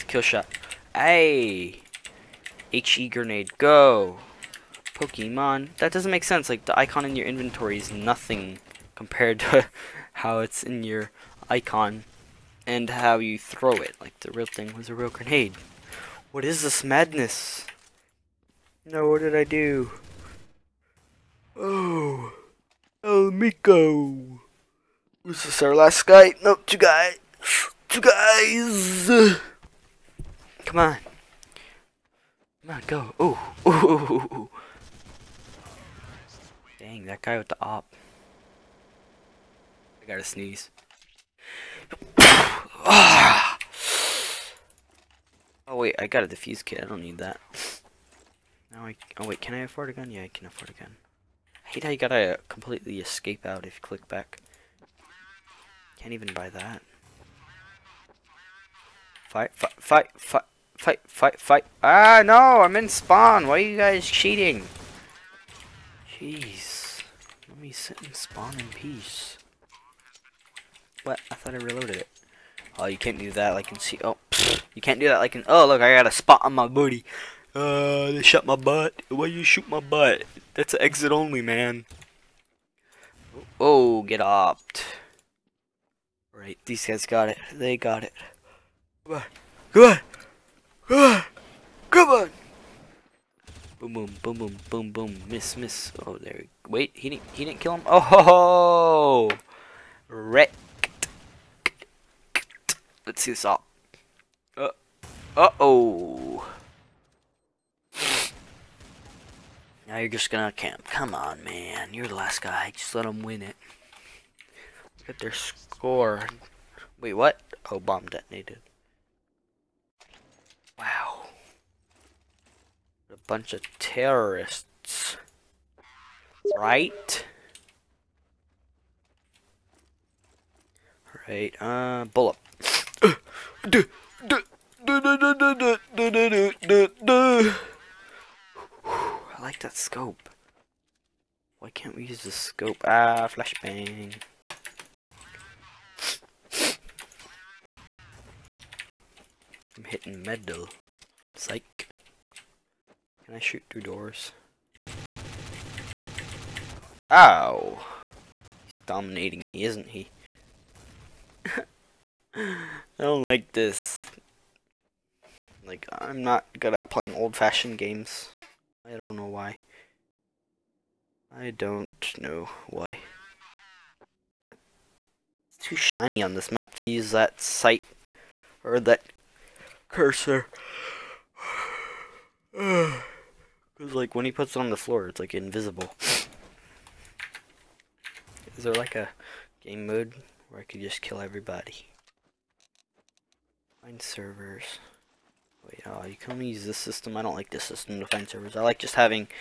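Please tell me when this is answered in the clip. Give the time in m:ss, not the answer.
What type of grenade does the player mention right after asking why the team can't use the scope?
2:23.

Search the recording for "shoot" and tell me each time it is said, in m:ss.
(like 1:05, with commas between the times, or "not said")
1:19, 2:33.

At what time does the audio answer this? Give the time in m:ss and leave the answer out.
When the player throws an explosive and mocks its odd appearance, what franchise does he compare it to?
0:04.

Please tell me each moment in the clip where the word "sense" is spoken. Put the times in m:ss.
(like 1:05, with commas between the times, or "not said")
0:06.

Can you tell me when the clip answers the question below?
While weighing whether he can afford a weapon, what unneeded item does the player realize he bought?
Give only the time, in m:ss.
0:46.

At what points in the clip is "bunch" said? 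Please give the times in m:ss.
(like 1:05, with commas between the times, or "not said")
2:03.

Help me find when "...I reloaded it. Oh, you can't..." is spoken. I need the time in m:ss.
1:11.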